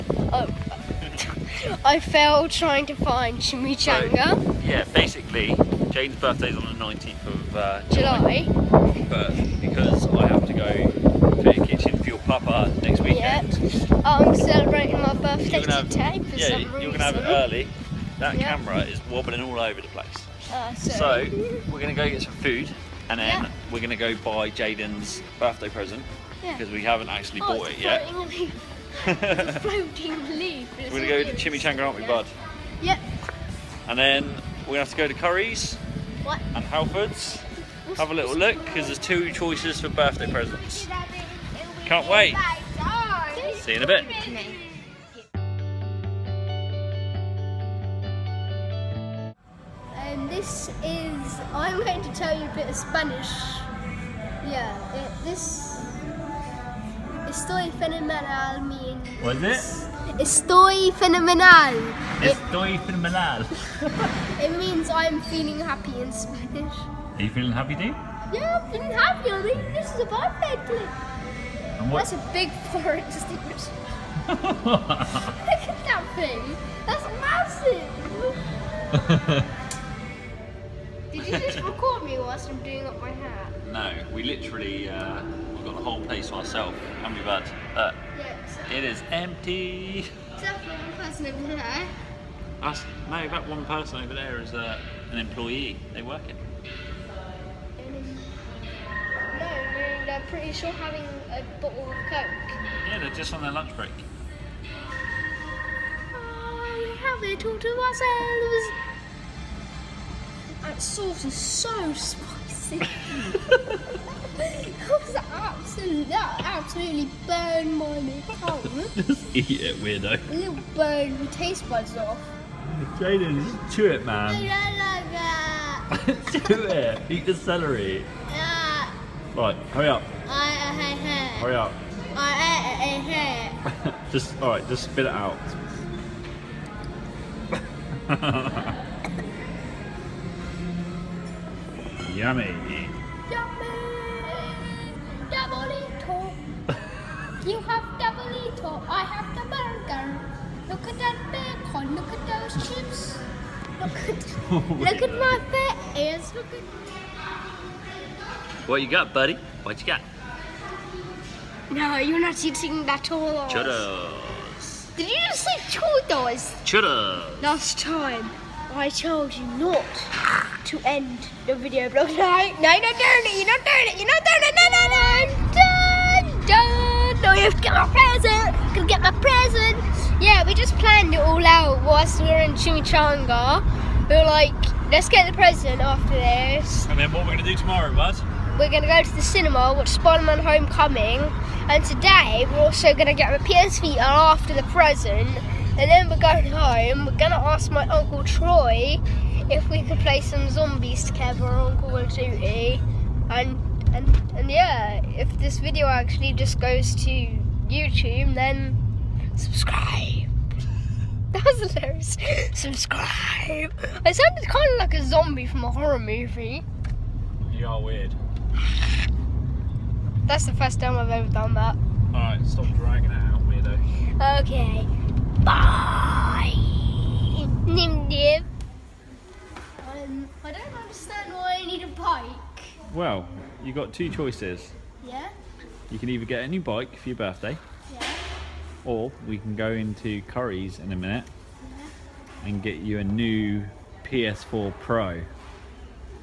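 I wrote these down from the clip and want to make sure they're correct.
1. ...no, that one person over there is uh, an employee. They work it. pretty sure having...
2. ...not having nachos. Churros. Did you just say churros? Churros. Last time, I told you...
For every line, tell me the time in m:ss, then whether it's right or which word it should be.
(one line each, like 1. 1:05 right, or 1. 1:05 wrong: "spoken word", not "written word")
1. 1:33 right
2. 2:42 wrong: "eating", not "having".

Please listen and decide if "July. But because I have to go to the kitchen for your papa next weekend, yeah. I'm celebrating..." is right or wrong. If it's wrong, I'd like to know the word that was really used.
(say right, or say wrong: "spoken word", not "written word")
right.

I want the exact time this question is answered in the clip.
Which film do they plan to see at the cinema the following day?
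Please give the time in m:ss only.
3:09.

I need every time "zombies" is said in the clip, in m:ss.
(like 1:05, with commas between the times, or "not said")
3:20, 3:35.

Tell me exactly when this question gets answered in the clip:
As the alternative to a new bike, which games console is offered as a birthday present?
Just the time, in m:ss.
4:04.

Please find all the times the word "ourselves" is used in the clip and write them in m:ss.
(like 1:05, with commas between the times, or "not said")
1:26, 1:47.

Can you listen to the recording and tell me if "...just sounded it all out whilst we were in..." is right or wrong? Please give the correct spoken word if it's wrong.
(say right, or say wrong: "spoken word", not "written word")
wrong: "planned", not "sounded".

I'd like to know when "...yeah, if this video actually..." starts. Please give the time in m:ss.
3:24.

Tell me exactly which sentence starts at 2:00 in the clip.
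A little burn your taste buds off.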